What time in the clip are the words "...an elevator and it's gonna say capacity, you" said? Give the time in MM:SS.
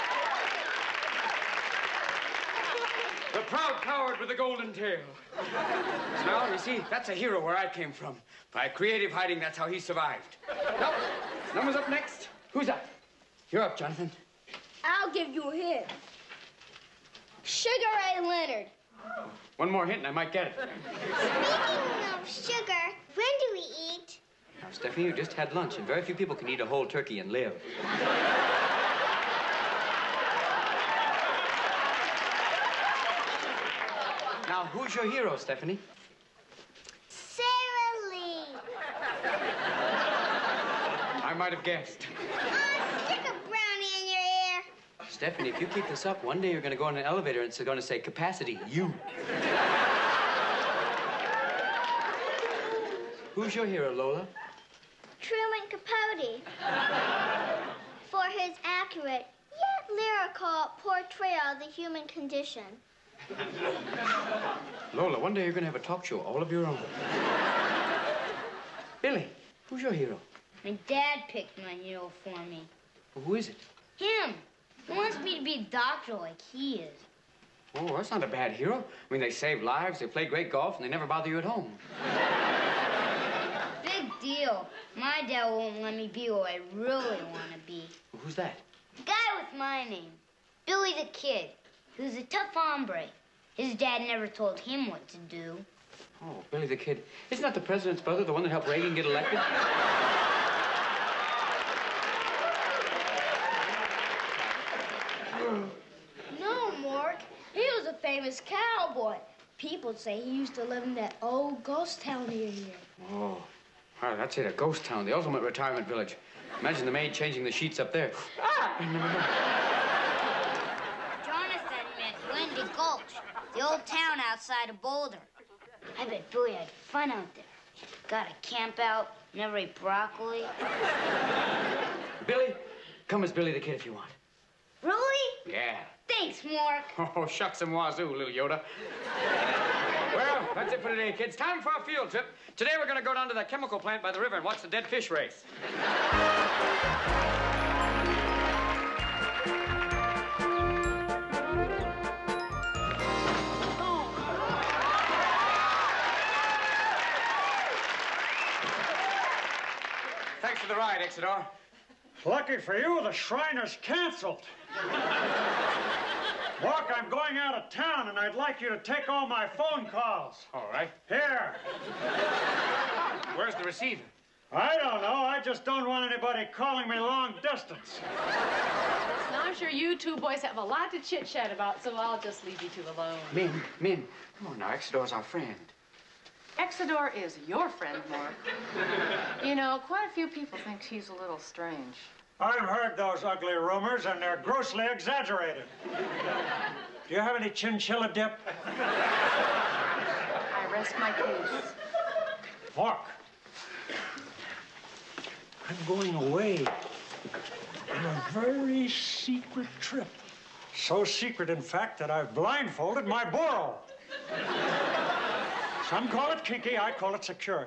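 00:46.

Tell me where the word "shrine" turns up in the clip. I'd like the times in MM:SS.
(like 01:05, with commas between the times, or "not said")
02:43.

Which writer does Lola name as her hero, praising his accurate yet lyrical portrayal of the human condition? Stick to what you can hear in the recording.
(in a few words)
Truman Capote.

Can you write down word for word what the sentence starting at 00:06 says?
Now, you see, that's a hero where I came from.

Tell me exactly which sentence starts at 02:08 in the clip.
Got a camp out, never eat broccoli.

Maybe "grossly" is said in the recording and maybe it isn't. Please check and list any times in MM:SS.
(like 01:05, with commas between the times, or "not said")
03:14.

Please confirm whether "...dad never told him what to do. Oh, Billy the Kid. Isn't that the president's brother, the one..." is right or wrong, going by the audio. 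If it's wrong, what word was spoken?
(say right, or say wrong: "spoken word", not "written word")
right.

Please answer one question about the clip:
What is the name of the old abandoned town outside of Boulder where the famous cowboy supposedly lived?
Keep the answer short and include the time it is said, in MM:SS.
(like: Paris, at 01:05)
Windy Gulch, at 02:02.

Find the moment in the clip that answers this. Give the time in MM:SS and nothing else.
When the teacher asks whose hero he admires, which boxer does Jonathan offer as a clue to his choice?
00:17.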